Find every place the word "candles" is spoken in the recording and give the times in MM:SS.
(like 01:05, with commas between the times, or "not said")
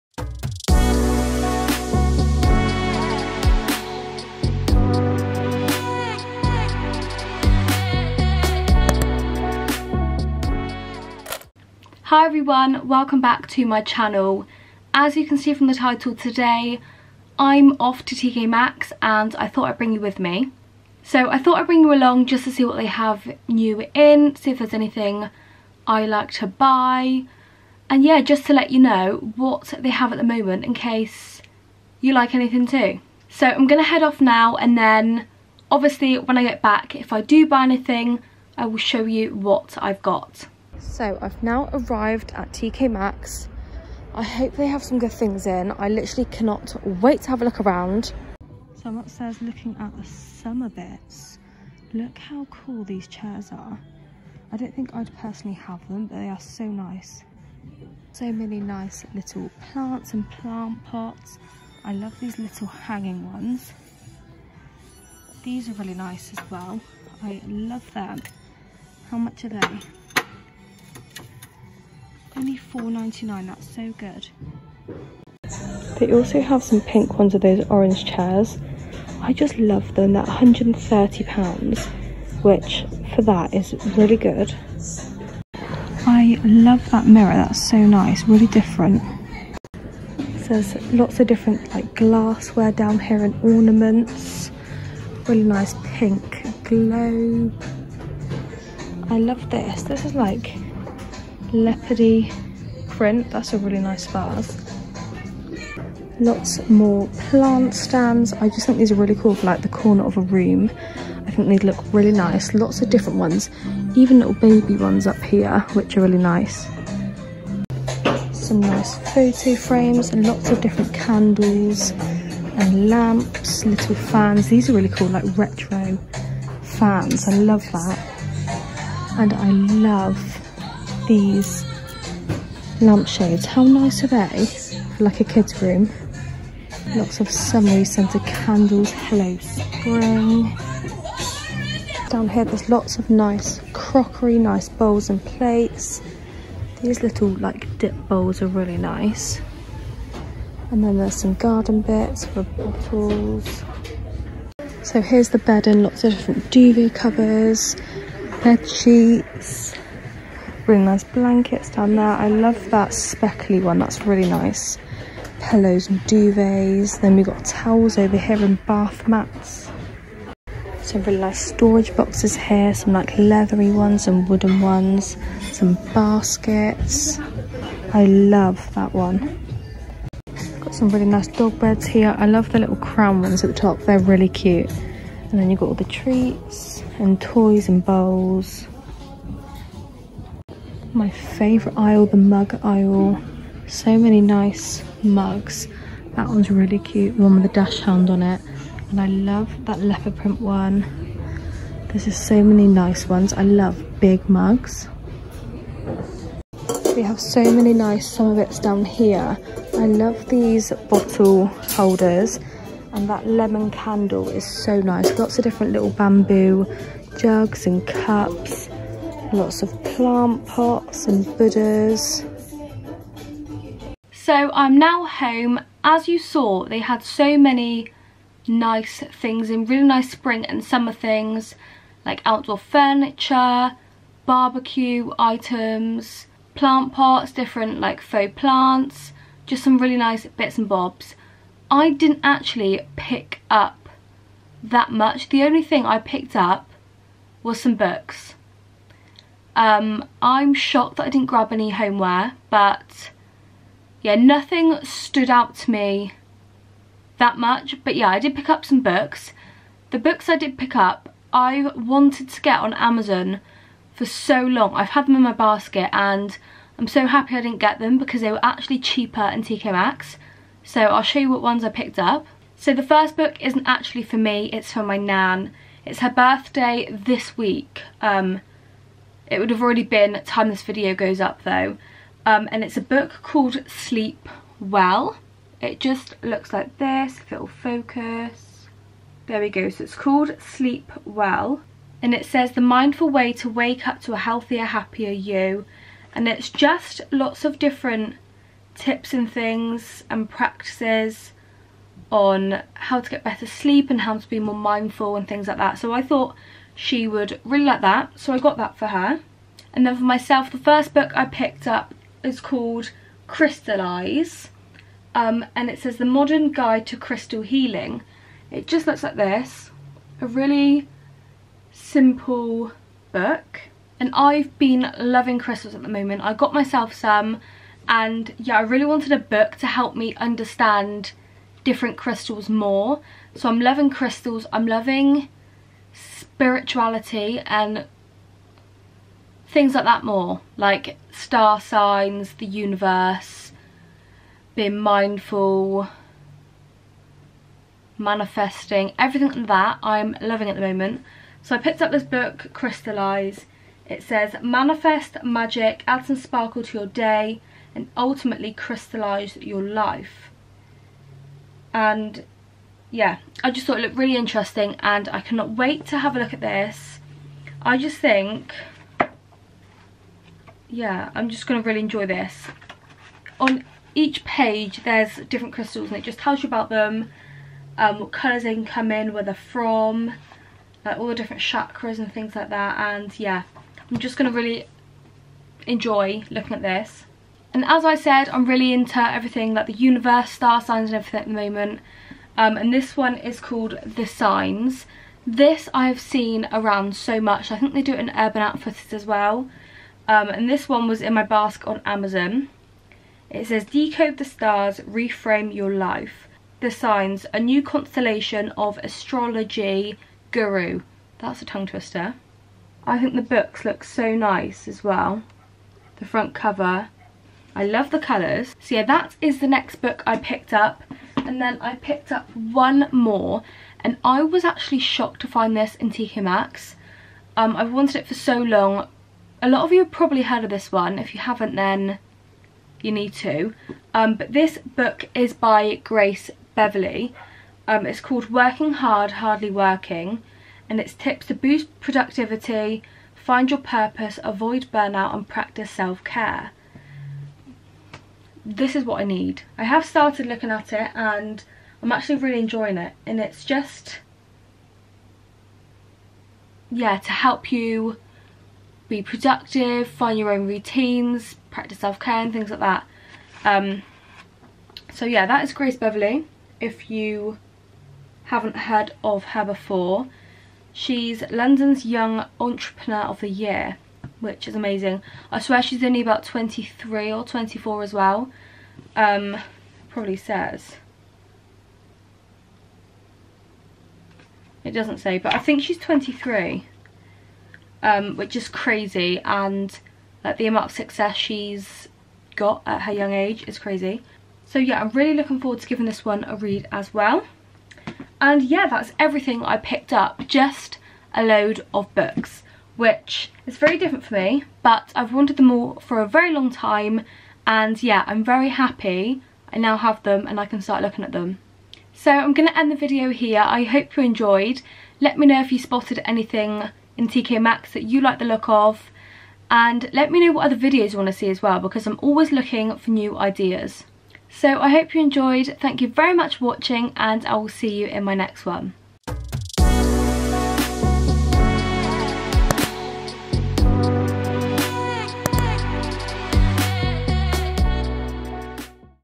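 02:00, 02:18, 03:33.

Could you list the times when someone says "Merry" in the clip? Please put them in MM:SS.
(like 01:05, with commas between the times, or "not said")
not said.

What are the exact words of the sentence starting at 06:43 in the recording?
It says, Decode the stars, reframe your life.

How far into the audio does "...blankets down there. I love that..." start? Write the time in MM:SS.
02:41.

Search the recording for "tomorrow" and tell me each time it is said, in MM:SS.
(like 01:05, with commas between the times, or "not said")
not said.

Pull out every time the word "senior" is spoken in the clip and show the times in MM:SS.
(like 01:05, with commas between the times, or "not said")
not said.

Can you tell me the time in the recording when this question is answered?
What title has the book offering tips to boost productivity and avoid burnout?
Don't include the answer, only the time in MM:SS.
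07:18.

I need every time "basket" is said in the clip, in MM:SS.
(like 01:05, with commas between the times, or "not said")
02:55, 04:25, 06:41.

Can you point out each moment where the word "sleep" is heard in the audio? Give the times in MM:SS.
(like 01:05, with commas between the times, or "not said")
04:43, 04:50, 05:03.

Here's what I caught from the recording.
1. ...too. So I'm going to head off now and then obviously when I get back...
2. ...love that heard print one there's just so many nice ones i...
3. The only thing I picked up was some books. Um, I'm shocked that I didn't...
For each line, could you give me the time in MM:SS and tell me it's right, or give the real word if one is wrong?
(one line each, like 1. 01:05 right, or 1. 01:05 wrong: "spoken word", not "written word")
1. 00:32 right
2. 03:19 wrong: "leopard", not "heard"
3. 04:05 right.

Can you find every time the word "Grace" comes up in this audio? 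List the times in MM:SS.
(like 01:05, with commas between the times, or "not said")
07:15, 07:45.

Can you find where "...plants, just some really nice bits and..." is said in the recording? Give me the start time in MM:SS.
03:58.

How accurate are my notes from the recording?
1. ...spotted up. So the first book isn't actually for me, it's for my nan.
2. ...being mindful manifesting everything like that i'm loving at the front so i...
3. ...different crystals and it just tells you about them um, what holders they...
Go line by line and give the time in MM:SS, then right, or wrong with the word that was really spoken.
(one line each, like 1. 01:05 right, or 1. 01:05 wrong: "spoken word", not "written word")
1. 04:31 wrong: "picked", not "spotted"
2. 05:44 wrong: "moment", not "front"
3. 06:15 wrong: "colours", not "holders".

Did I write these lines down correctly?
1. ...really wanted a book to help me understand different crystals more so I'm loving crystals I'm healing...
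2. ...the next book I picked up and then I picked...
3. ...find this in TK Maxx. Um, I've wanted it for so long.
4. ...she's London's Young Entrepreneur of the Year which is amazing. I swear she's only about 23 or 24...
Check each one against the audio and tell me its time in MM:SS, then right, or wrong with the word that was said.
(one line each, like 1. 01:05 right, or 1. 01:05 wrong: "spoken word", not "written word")
1. 05:28 wrong: "loving", not "healing"
2. 06:59 right
3. 07:05 right
4. 07:50 right.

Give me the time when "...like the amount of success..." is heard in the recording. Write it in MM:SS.
08:10.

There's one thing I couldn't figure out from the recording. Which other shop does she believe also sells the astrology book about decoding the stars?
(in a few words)
Urban Outfitters.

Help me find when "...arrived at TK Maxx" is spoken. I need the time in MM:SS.
00:41.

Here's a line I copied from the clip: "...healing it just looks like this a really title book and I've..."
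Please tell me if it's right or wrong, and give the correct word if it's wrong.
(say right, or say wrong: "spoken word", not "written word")
wrong: "simple", not "title".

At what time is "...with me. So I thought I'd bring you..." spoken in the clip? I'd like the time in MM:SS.
00:20.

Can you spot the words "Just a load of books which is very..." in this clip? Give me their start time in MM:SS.
08:20.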